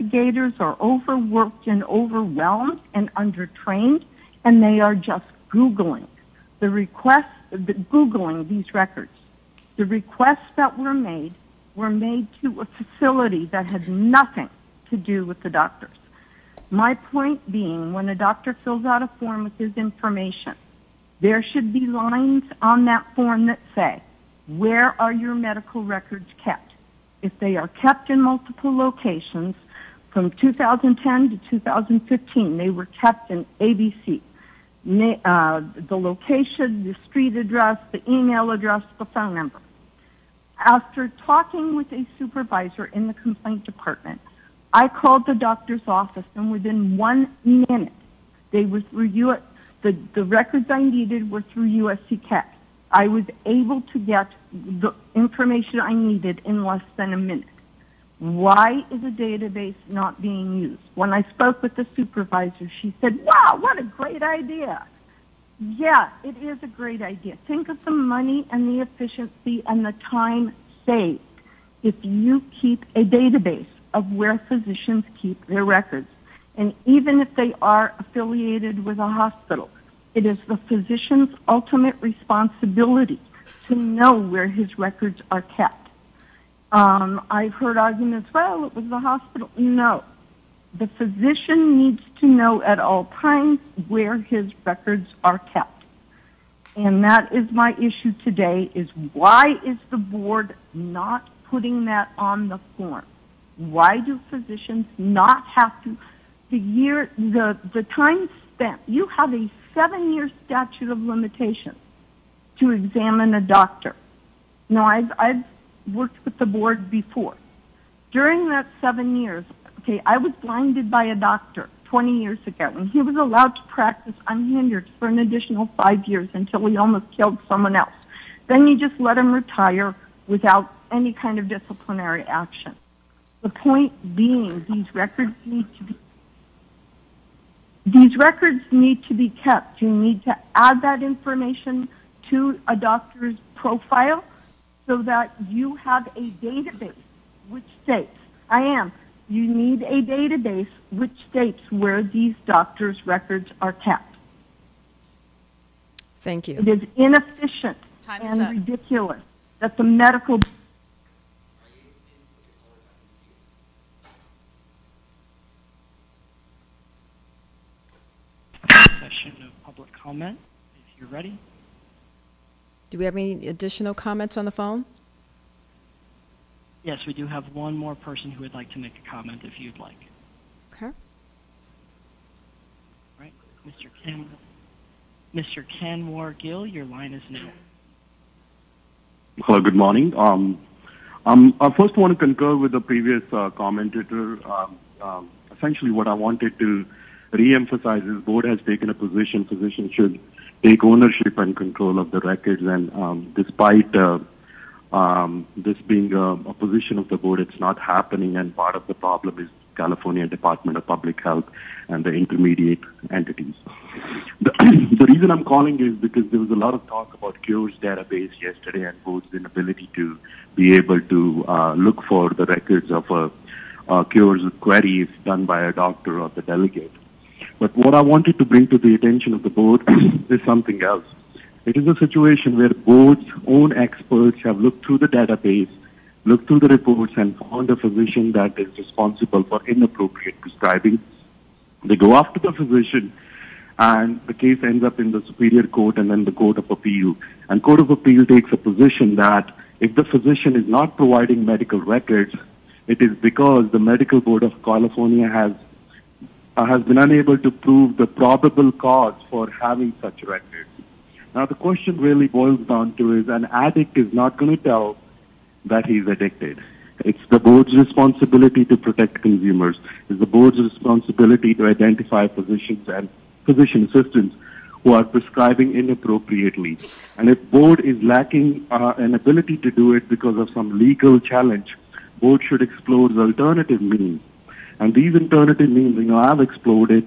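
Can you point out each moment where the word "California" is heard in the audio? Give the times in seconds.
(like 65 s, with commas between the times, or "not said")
209 s, 254 s.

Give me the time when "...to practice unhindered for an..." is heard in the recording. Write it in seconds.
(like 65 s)
123 s.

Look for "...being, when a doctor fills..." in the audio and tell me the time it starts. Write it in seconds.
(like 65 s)
17 s.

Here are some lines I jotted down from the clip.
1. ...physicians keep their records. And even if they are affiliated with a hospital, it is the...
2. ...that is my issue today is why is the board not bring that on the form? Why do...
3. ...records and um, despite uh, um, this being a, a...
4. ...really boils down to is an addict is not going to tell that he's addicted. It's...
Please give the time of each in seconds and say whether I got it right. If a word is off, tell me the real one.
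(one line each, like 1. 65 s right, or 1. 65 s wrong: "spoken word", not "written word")
1. 74 s right
2. 97 s wrong: "putting", not "bring"
3. 202 s right
4. 261 s right.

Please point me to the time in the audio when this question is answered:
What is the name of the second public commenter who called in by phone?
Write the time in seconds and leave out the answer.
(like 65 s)
185 s.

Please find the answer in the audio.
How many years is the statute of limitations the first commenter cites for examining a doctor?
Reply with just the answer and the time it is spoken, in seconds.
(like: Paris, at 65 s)
7, at 109 s.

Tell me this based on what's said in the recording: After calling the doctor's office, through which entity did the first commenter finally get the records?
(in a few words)
USC CAT.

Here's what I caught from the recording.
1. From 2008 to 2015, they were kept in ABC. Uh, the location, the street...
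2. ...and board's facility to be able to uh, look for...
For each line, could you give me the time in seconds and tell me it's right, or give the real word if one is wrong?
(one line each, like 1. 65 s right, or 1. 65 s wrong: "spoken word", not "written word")
1. 30 s wrong: "2010", not "2008"
2. 218 s wrong: "inability", not "facility".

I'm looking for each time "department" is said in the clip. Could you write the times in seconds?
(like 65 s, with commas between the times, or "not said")
43 s, 210 s.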